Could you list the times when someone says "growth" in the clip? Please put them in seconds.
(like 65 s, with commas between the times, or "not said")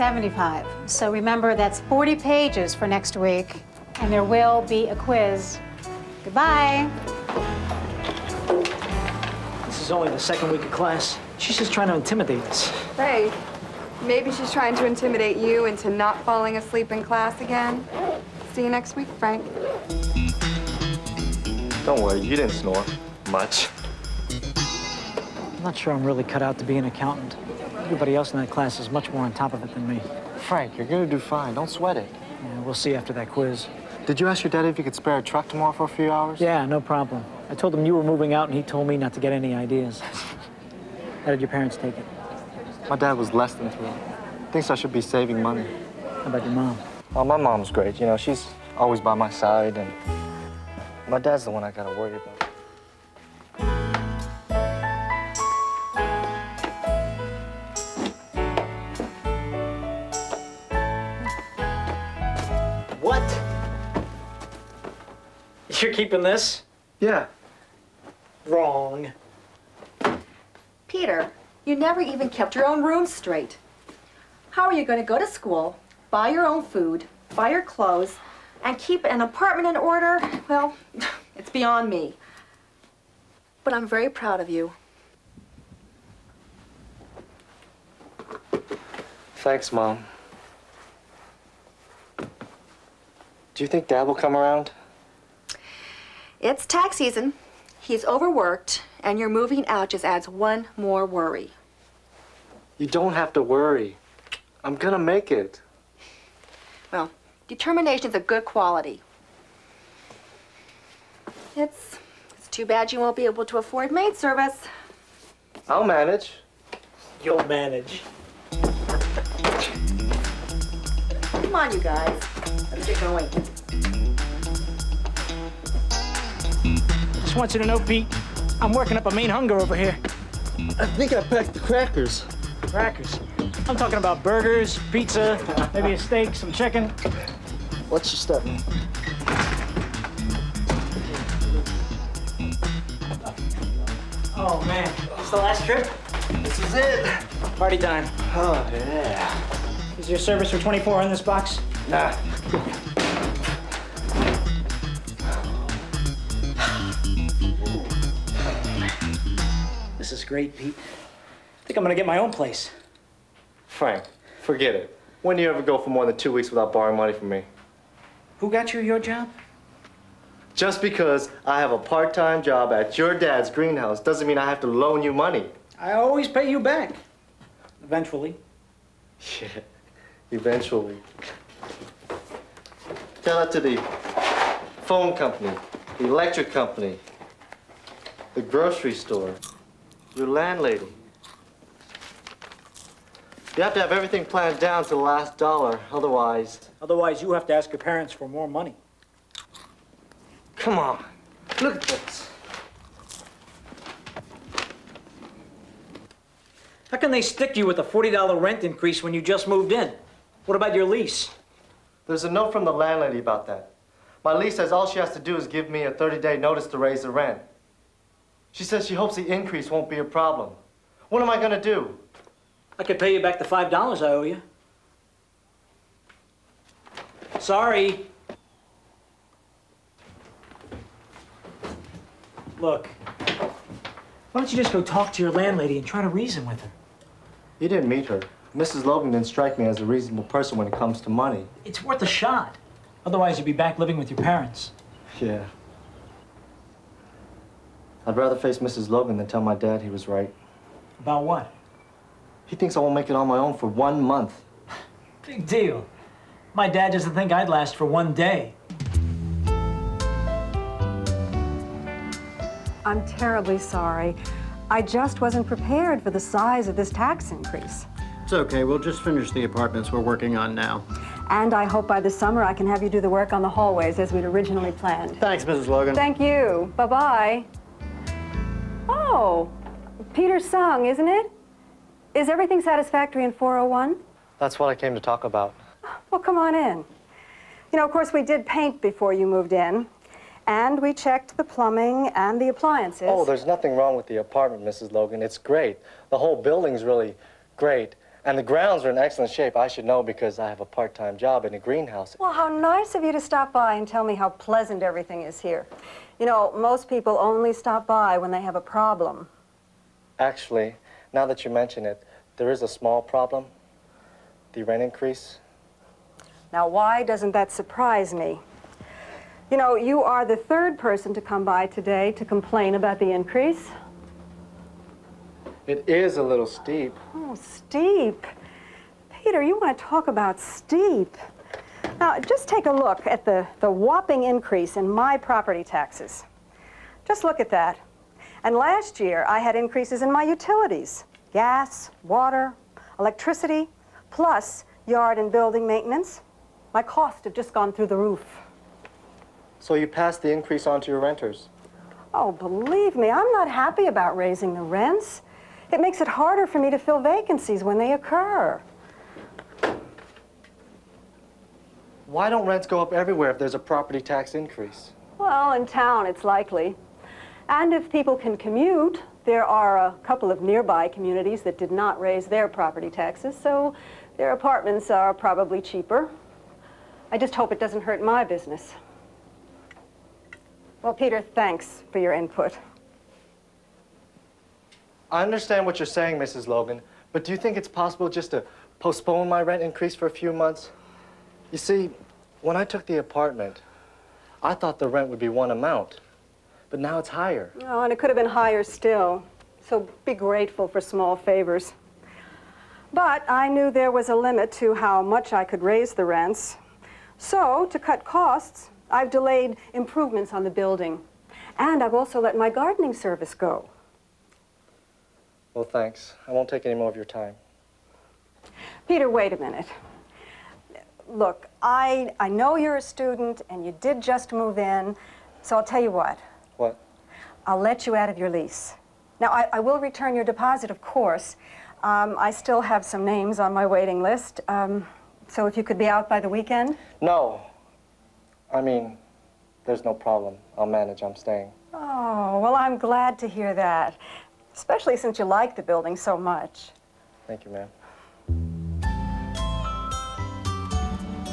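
not said.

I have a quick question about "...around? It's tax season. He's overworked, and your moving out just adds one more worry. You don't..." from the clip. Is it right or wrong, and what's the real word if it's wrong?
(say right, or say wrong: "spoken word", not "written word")
right.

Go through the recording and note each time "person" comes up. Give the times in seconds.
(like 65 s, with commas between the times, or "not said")
240 s, 320 s.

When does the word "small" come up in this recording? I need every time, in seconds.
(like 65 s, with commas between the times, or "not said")
312 s, 400 s.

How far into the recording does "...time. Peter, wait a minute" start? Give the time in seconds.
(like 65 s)
417 s.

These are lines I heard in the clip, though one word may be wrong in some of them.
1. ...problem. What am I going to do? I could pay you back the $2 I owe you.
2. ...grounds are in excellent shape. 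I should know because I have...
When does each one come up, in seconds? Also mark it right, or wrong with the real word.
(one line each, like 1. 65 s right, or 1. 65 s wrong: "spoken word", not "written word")
1. 220 s wrong: "5", not "2"
2. 298 s right.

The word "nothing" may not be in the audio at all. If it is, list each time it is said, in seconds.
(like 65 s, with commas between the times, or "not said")
293 s.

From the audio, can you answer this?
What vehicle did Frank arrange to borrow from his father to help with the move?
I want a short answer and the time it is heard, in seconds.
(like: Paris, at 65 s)
A truck, at 35 s.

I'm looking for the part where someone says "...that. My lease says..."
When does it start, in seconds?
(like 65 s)
213 s.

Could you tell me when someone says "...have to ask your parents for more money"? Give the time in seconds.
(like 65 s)
197 s.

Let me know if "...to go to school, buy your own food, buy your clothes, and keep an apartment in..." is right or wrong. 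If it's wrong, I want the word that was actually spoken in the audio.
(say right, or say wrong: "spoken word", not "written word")
right.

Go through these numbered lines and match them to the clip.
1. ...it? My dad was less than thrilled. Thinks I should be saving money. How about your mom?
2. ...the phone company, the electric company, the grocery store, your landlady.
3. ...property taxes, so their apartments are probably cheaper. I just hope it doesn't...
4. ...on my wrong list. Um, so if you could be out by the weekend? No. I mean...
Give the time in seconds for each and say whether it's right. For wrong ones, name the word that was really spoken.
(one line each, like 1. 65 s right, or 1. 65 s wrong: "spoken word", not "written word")
1. 41 s right
2. 183 s right
3. 372 s right
4. 433 s wrong: "waiting", not "wrong".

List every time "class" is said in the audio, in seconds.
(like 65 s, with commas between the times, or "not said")
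10 s, 17 s, 28 s.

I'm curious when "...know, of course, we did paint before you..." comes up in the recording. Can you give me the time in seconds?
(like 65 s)
287 s.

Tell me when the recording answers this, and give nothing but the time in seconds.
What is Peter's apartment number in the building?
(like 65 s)
283 s.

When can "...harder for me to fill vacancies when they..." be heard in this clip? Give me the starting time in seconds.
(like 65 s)
356 s.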